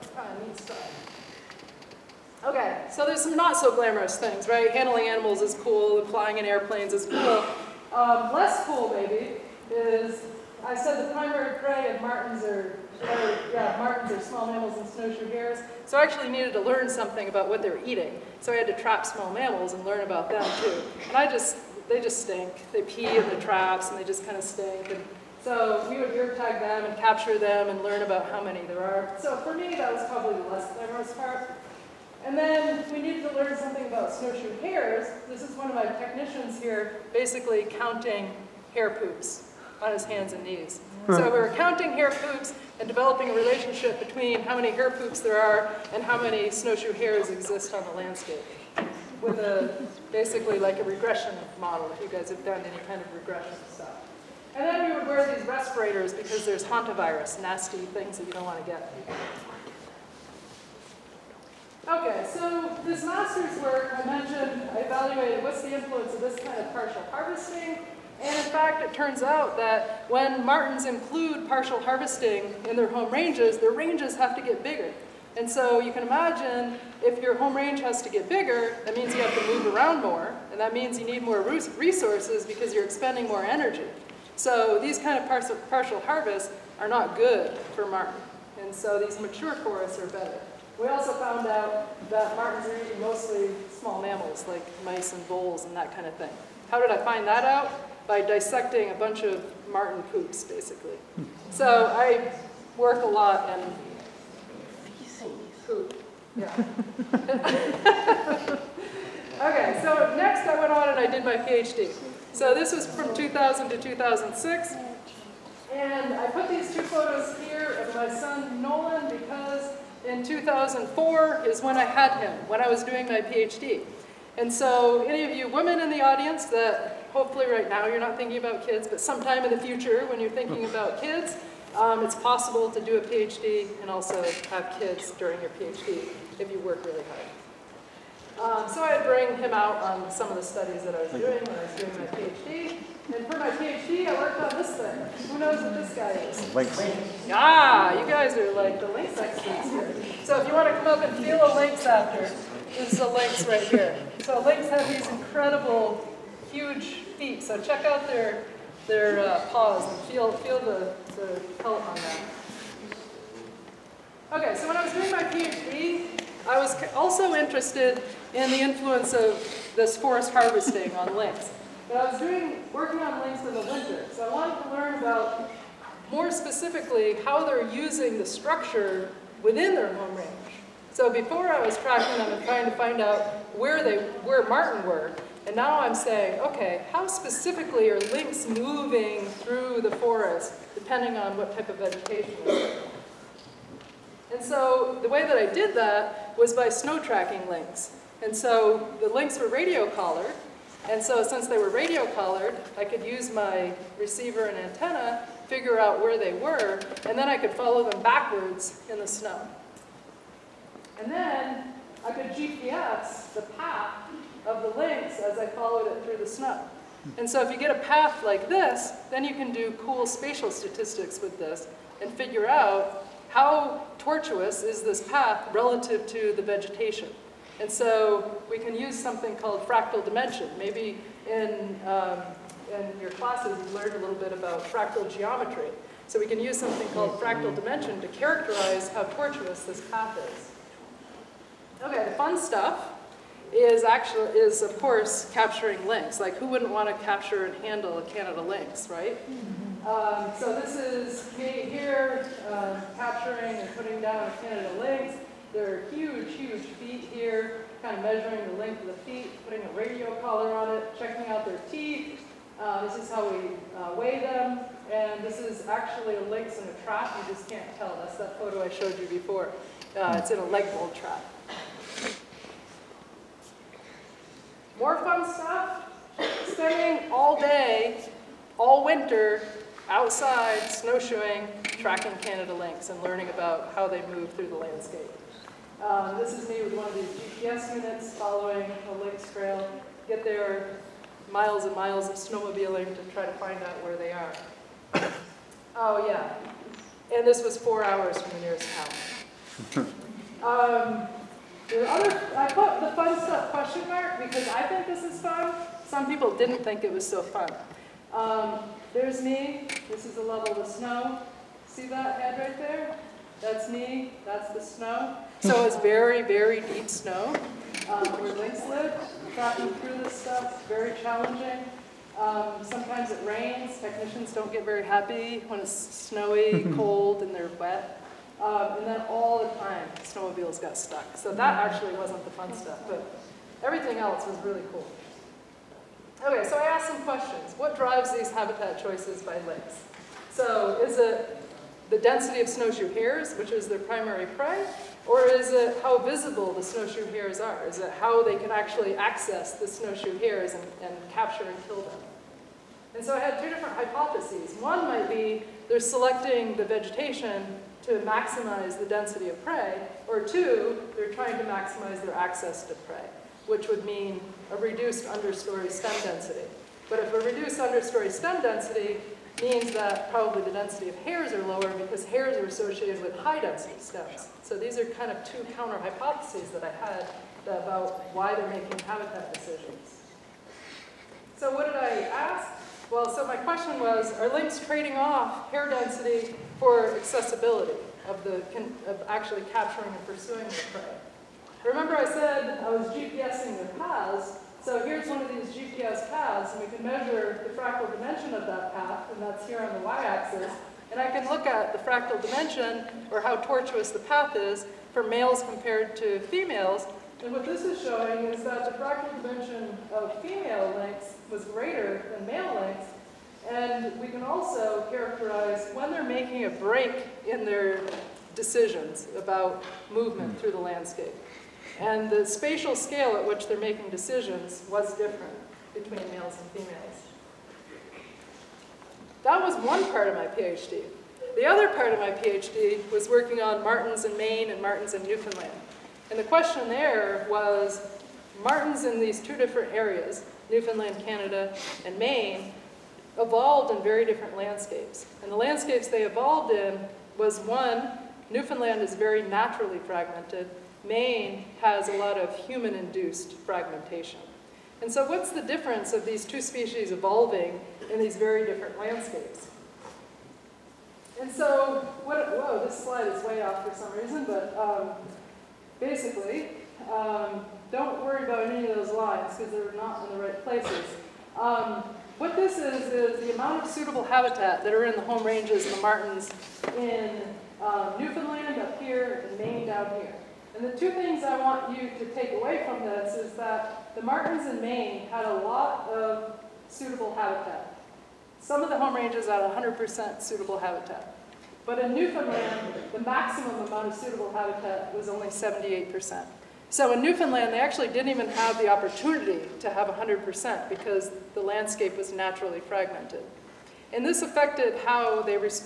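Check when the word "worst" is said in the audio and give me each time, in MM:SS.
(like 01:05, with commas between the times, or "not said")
not said.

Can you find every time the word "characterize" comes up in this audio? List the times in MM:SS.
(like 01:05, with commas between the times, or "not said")
03:58, 06:54.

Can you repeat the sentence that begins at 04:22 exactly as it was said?
Uh, this is how we uh, weigh them.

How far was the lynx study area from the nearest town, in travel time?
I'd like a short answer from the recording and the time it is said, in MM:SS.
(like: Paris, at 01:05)
4 hours, at 04:57.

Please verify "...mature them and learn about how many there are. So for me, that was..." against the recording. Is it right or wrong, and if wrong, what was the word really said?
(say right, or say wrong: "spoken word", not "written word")
wrong: "capture", not "mature".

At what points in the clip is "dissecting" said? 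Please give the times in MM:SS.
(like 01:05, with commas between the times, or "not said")
01:38.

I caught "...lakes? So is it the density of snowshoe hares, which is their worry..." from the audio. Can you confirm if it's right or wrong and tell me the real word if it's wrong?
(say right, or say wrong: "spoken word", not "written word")
wrong: "primary", not "worry".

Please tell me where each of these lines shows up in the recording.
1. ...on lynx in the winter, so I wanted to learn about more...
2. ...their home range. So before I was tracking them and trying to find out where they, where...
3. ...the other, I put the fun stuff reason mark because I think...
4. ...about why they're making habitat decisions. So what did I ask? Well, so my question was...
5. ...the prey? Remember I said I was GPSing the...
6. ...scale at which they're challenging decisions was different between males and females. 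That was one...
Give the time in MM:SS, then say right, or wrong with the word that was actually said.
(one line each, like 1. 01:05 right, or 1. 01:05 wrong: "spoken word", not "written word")
1. 02:52 right
2. 02:59 right
3. 05:01 wrong: "question", not "reason"
4. 06:17 right
5. 06:30 right
6. 07:02 wrong: "making", not "challenging".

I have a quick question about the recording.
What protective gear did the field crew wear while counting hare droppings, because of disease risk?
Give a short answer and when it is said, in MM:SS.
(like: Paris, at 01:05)
Respirators, at 00:55.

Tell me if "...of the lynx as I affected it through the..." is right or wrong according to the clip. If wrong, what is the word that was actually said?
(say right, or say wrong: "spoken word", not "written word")
wrong: "followed", not "affected".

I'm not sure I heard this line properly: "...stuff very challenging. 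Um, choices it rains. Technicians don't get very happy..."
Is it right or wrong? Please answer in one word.
wrong.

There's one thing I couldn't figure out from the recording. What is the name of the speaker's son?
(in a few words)
Nolan.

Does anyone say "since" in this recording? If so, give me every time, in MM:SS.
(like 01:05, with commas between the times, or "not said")
03:21.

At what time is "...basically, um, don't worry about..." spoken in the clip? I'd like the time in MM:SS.
07:45.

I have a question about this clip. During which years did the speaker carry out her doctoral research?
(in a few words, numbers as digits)
2000 to 2006.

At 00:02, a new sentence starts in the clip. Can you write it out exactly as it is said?
Okay, so there's some not so glamorous things, right?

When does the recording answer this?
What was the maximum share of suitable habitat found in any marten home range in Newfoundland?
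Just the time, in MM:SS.
08:15.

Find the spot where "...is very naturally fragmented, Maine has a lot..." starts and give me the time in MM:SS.
07:28.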